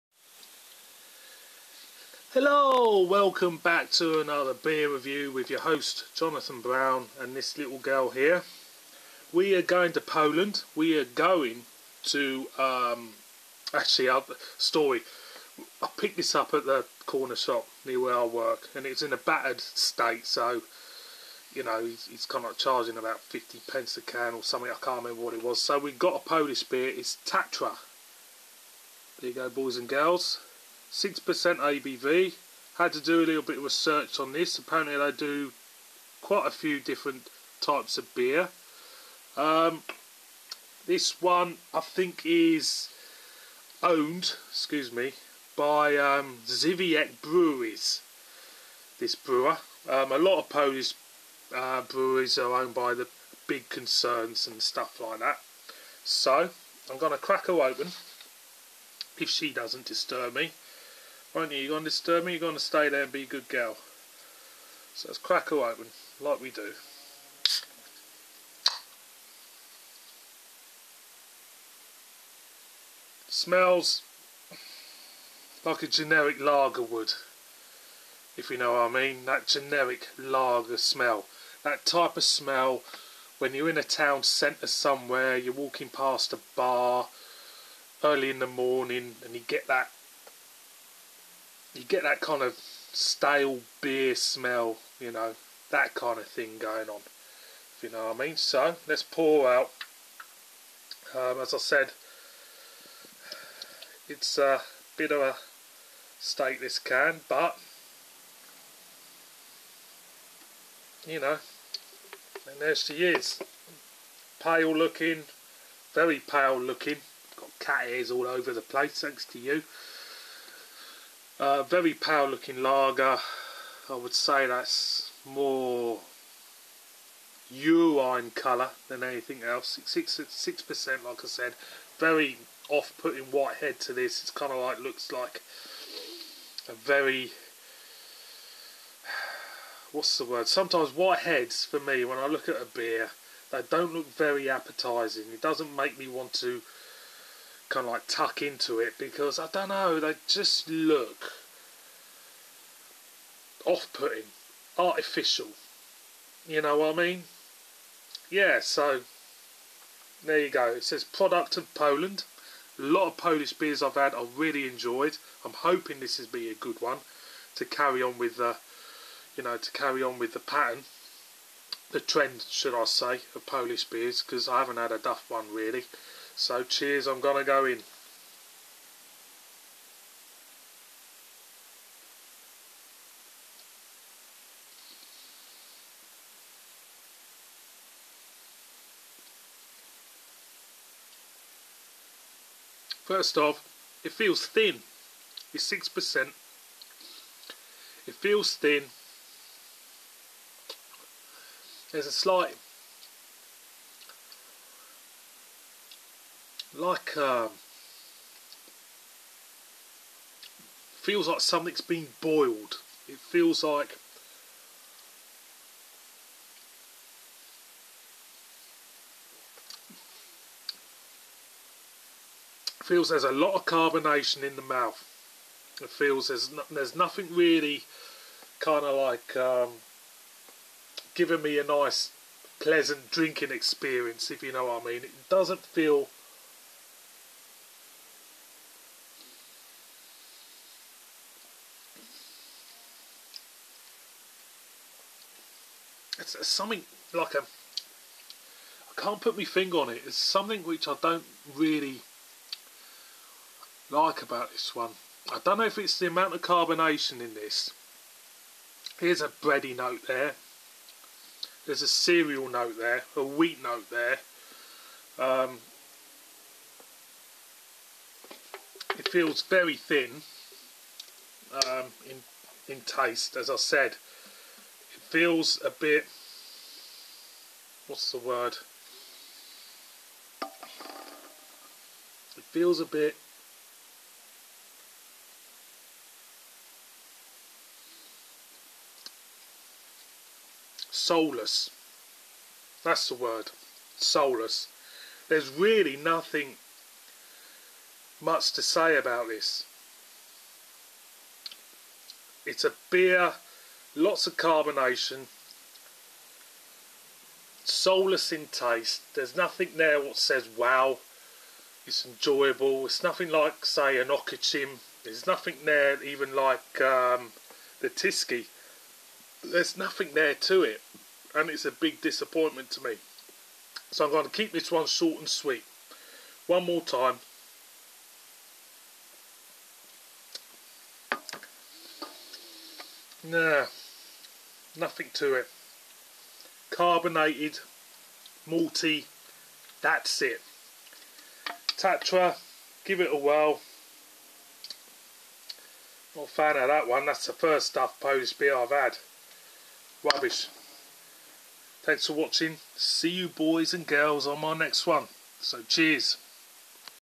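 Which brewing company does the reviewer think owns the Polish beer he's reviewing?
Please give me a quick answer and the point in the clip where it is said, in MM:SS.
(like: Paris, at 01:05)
Żywiec Breweries, at 00:46.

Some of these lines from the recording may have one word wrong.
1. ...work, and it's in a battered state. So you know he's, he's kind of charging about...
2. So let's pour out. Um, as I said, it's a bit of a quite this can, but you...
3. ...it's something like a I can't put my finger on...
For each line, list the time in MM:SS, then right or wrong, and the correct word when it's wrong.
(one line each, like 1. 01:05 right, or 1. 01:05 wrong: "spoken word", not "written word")
1. 00:18 right
2. 01:38 wrong: "state", not "quite"
3. 04:06 right.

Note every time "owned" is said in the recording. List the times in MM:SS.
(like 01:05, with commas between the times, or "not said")
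00:43, 00:52.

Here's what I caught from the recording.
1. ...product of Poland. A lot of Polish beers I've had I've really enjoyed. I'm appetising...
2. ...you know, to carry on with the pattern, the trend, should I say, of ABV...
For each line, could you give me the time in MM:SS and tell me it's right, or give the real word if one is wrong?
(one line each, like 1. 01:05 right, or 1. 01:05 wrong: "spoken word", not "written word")
1. 02:41 wrong: "hoping", not "appetising"
2. 02:49 wrong: "Polish", not "ABV".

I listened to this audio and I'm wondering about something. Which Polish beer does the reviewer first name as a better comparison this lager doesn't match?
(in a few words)
Okocim.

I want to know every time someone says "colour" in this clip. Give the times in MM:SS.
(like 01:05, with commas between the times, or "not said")
02:08.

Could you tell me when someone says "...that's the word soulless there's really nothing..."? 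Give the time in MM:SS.
04:52.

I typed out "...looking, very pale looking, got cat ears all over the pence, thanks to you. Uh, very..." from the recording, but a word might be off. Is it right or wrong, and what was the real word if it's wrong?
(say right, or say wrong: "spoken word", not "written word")
wrong: "place", not "pence".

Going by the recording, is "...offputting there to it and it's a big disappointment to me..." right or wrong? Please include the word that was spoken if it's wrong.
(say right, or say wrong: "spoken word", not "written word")
wrong: "nothing", not "offputting".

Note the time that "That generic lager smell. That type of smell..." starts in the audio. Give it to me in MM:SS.
01:19.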